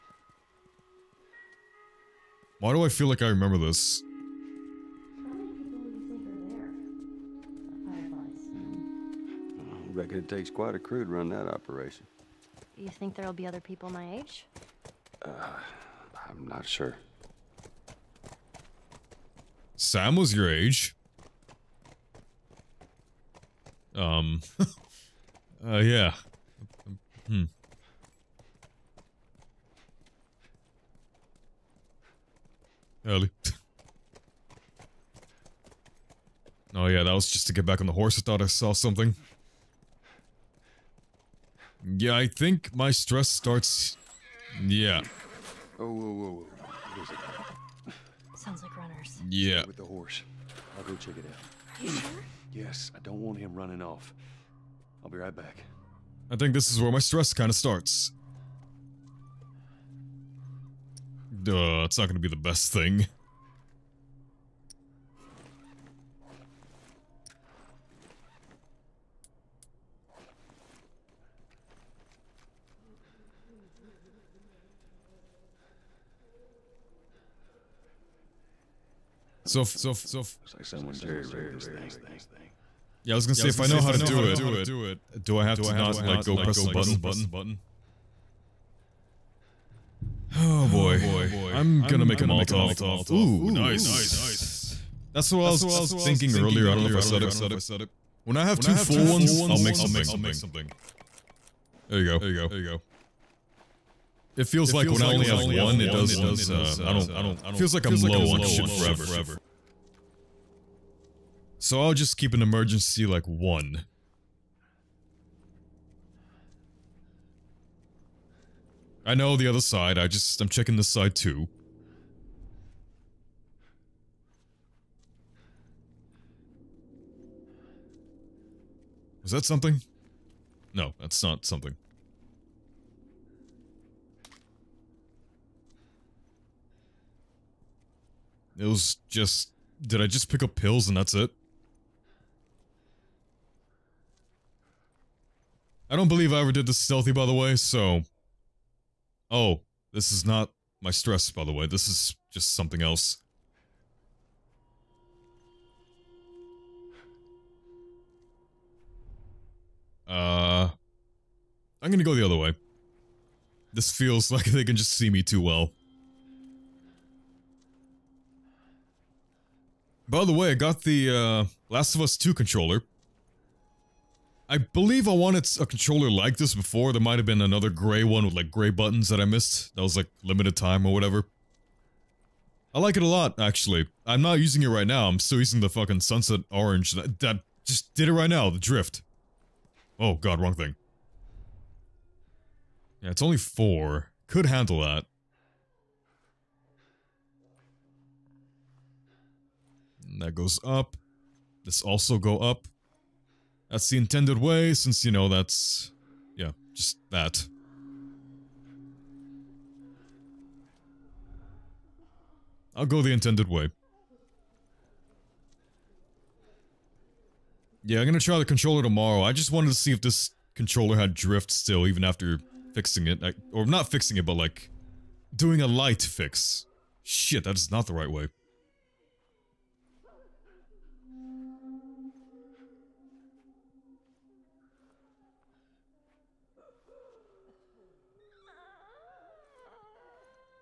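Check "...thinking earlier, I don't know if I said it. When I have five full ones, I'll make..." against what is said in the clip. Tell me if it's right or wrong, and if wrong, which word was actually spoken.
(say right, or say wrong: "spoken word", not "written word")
wrong: "two", not "five".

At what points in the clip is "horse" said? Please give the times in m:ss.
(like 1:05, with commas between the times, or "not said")
0:37, 0:49.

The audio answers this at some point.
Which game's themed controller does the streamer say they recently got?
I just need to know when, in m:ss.
2:51.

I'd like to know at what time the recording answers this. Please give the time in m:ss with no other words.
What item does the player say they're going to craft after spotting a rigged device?
1:32.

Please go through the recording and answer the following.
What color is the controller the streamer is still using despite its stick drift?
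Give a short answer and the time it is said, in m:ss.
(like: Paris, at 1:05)
sunset orange, at 3:06.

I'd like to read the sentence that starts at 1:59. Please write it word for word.
I know the other side, I just- I'm checking this side too.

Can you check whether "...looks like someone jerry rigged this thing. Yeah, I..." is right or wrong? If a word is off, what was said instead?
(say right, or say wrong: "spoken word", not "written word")
right.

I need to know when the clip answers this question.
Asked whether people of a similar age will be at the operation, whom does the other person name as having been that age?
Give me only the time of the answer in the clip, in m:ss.
0:19.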